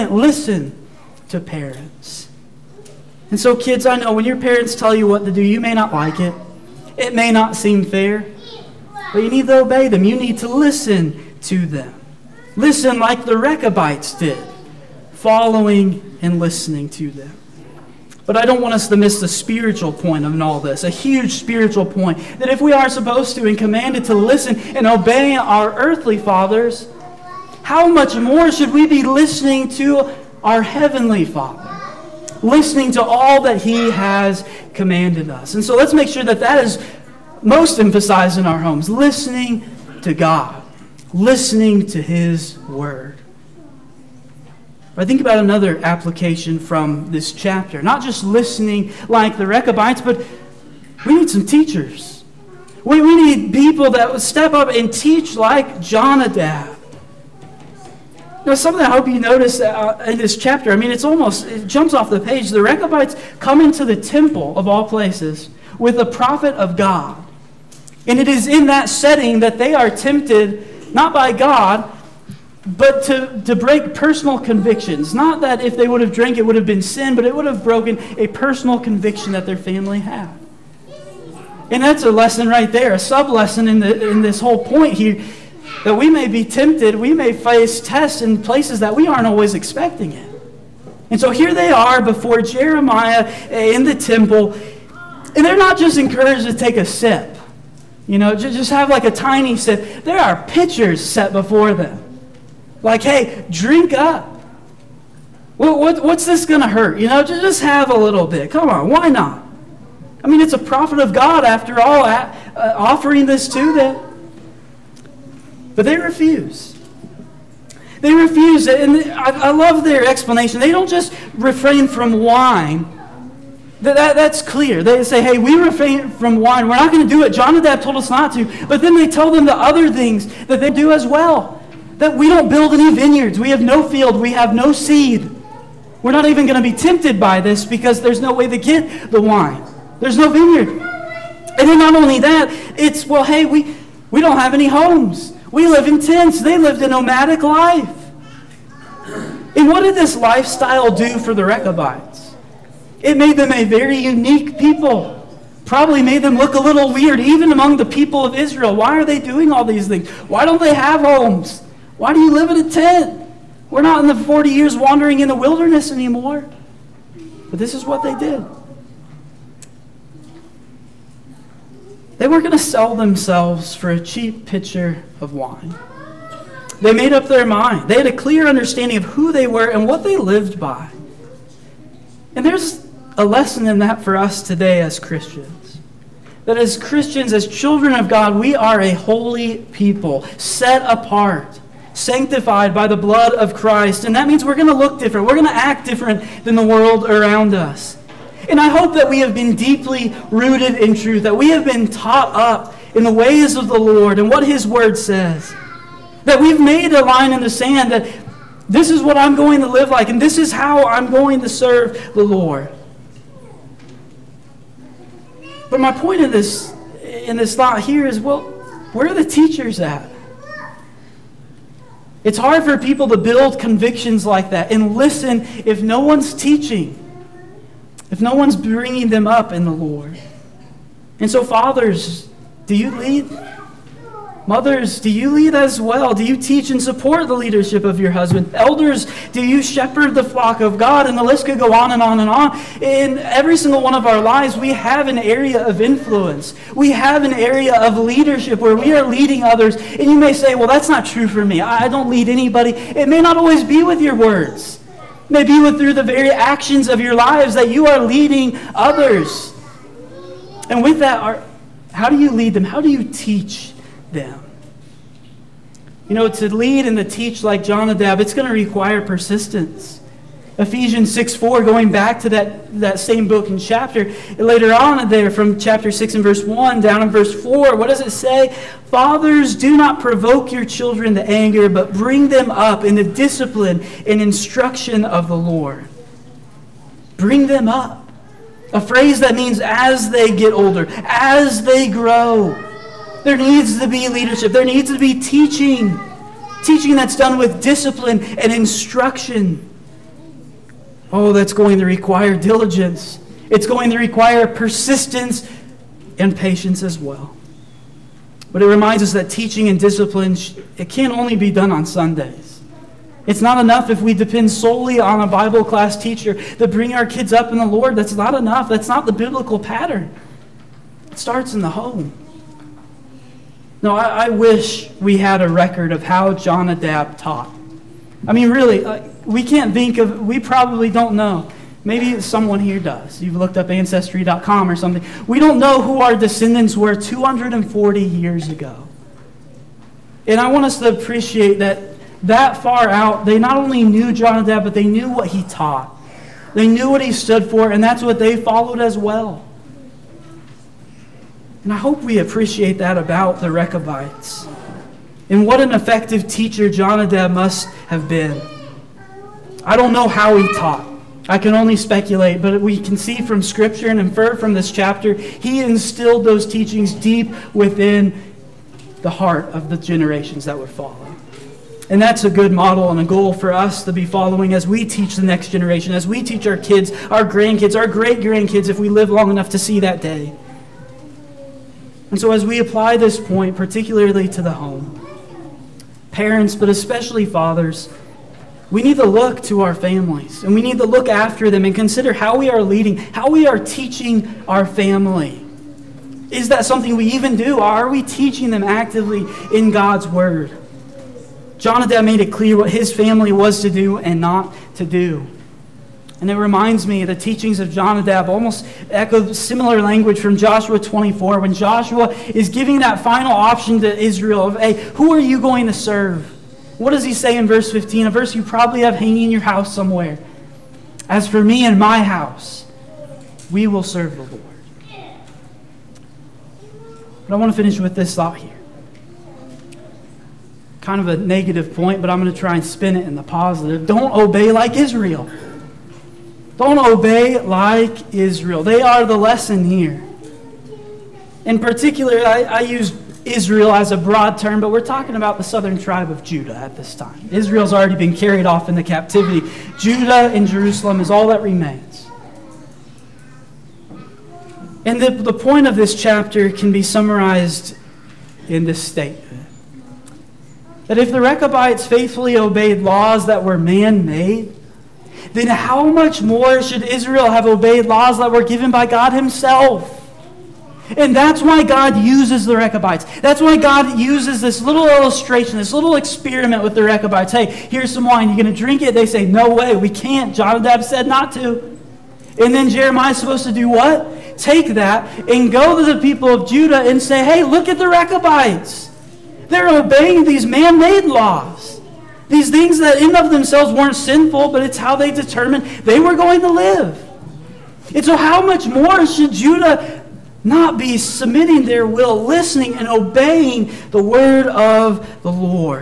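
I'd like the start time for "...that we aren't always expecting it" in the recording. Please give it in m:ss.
1:28.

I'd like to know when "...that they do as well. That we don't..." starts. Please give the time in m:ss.
2:10.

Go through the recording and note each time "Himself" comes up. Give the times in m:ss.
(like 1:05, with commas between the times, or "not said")
7:49.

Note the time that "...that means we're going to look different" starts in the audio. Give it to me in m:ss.
3:14.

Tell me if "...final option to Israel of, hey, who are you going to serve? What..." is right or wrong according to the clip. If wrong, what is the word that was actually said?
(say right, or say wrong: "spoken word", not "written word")
right.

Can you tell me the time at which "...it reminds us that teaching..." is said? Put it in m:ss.
5:08.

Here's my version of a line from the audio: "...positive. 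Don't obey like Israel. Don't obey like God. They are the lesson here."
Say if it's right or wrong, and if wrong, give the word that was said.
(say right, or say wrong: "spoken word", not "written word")
wrong: "Israel", not "God".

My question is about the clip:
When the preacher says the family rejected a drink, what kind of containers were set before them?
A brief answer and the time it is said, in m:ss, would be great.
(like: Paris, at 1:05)
Pitchers, at 1:40.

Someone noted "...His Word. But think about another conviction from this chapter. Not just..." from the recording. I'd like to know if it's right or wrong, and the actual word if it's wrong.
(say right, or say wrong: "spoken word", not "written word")
wrong: "application", not "conviction".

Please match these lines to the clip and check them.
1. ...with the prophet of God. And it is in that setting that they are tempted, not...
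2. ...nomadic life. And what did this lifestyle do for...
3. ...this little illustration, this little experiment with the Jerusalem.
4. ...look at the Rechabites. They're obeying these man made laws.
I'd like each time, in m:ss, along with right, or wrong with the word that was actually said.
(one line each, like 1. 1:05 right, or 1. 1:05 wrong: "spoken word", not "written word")
1. 1:05 right
2. 2:26 right
3. 7:54 wrong: "Rechabites", not "Jerusalem"
4. 8:07 right.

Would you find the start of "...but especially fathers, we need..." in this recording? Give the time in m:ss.
6:26.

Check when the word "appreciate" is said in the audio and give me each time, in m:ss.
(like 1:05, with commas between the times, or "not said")
5:40, 5:52.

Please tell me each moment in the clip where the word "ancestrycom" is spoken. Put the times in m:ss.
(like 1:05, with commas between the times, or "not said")
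5:33.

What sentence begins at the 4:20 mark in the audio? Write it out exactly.
And with that, our, how do you lead them?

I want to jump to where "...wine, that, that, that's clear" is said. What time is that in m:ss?
2:02.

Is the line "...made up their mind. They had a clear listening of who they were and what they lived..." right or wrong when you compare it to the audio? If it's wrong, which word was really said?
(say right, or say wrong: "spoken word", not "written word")
wrong: "understanding", not "listening".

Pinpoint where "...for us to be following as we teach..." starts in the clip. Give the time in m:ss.
6:13.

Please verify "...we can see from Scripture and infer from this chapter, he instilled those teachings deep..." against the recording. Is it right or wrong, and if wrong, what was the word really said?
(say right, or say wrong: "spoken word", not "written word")
right.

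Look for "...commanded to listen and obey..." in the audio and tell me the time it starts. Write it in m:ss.
0:23.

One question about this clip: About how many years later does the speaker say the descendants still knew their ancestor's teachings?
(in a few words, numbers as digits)
240.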